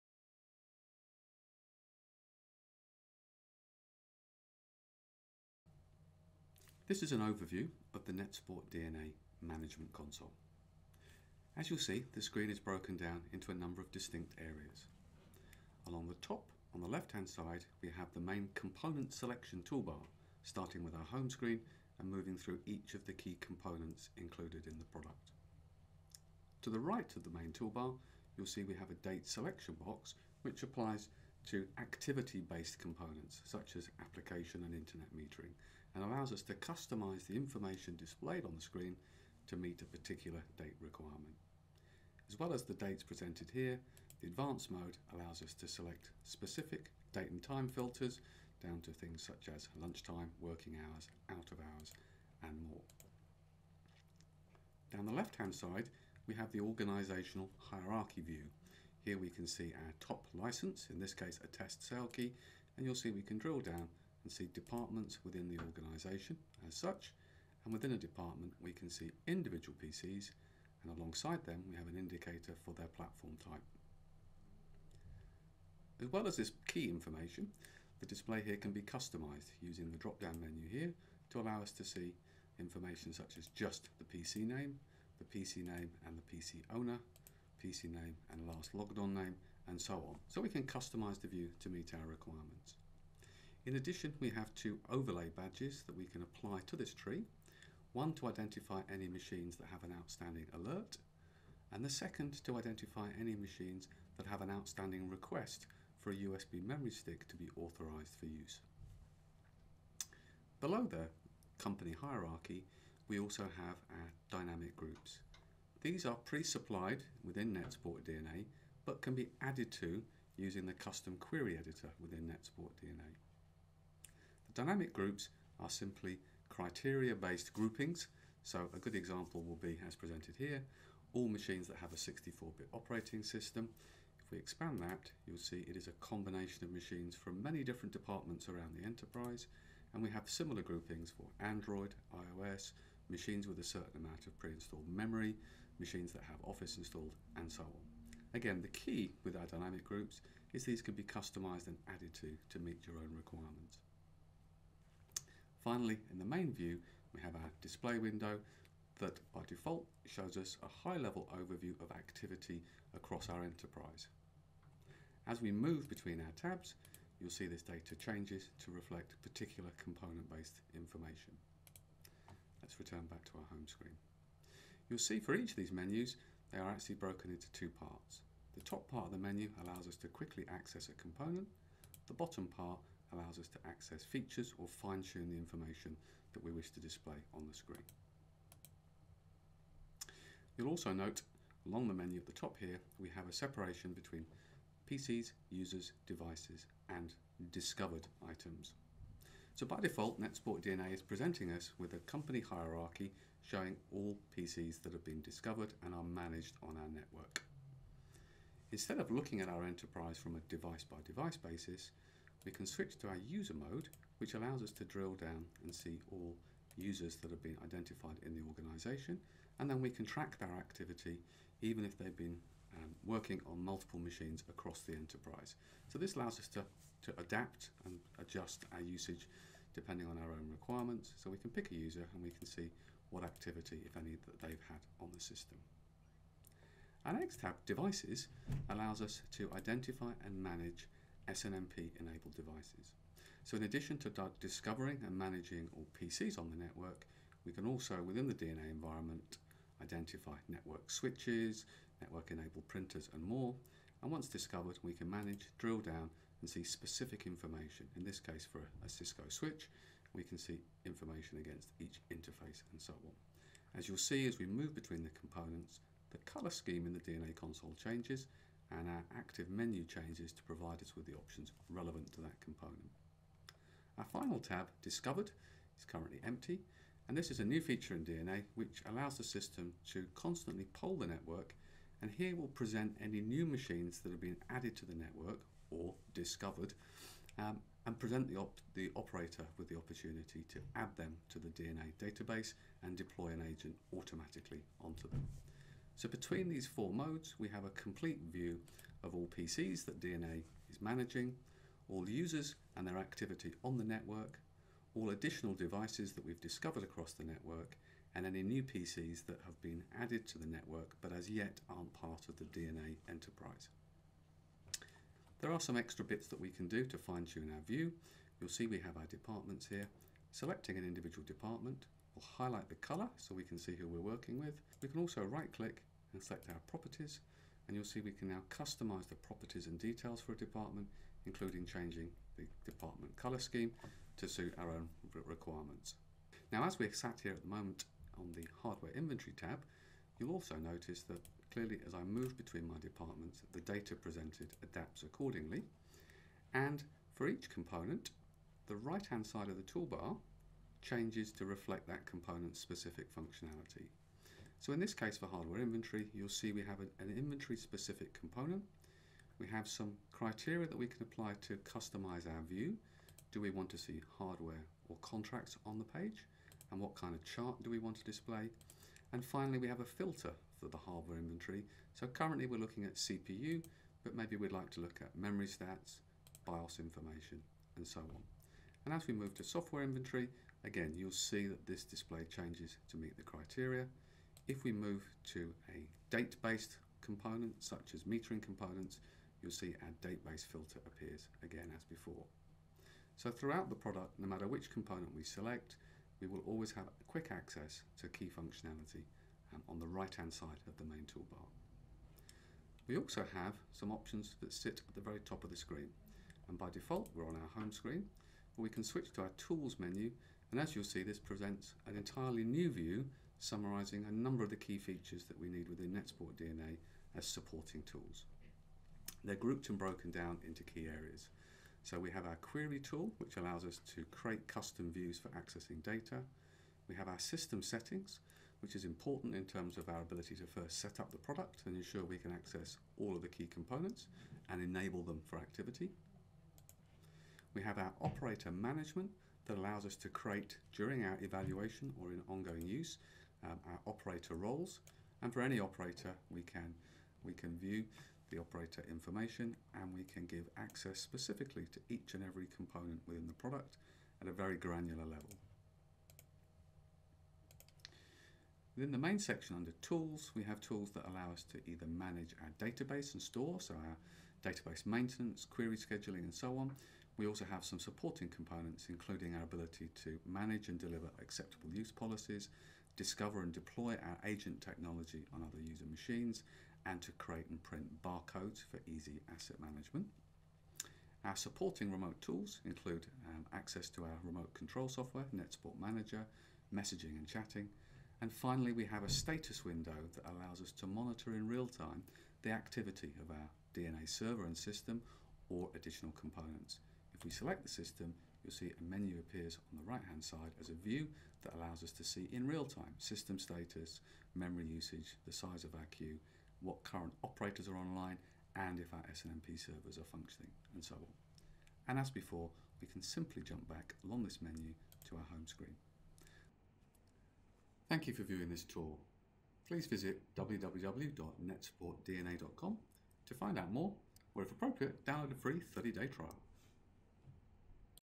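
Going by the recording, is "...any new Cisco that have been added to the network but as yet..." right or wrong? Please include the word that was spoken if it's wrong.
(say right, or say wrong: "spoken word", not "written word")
wrong: "PCs", not "Cisco".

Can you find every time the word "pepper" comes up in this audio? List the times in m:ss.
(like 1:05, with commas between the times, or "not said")
not said.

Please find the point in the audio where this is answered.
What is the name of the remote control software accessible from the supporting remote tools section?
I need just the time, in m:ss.
8:05.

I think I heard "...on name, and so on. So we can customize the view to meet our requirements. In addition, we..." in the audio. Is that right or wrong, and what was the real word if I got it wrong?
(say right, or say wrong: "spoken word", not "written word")
right.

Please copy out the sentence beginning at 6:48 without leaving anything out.
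But we can switch to our tools menu.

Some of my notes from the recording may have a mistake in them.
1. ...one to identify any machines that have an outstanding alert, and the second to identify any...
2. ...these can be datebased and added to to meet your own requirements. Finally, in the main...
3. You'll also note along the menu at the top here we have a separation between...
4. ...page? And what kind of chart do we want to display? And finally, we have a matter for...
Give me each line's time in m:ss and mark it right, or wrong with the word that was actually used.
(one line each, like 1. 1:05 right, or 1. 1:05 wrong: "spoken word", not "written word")
1. 1:37 right
2. 2:30 wrong: "customized", not "datebased"
3. 3:10 right
4. 6:05 wrong: "filter", not "matter".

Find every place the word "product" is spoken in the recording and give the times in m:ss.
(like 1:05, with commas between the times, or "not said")
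0:24, 6:33, 7:11, 7:33.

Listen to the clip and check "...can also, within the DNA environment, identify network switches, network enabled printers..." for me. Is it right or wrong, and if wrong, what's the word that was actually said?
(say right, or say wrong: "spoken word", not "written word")
right.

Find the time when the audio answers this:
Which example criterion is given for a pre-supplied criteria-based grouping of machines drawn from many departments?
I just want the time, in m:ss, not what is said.
2:11.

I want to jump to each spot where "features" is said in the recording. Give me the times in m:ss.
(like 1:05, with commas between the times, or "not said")
3:04, 4:37, 6:54.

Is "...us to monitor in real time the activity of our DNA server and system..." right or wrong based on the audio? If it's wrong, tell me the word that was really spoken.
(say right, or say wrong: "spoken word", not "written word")
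right.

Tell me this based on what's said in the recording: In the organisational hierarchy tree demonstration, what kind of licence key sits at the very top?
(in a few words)
Test sale key.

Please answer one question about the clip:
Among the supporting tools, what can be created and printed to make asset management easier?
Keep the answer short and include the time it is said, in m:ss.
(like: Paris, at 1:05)
Barcodes, at 7:58.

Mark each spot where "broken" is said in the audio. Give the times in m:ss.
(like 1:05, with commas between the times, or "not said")
0:12, 2:56, 6:59.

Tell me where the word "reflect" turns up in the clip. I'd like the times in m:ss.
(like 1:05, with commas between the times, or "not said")
2:48, 5:51.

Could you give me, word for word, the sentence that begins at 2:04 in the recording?
Dynamic groups are simply criteria-based groupings.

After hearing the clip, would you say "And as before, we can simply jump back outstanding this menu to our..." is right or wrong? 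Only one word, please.
wrong.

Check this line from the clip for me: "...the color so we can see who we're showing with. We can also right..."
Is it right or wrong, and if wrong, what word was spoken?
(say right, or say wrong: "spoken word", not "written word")
wrong: "working", not "showing".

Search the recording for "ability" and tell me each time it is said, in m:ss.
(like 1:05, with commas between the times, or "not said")
7:10, 7:49.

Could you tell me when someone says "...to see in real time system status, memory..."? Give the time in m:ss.
8:21.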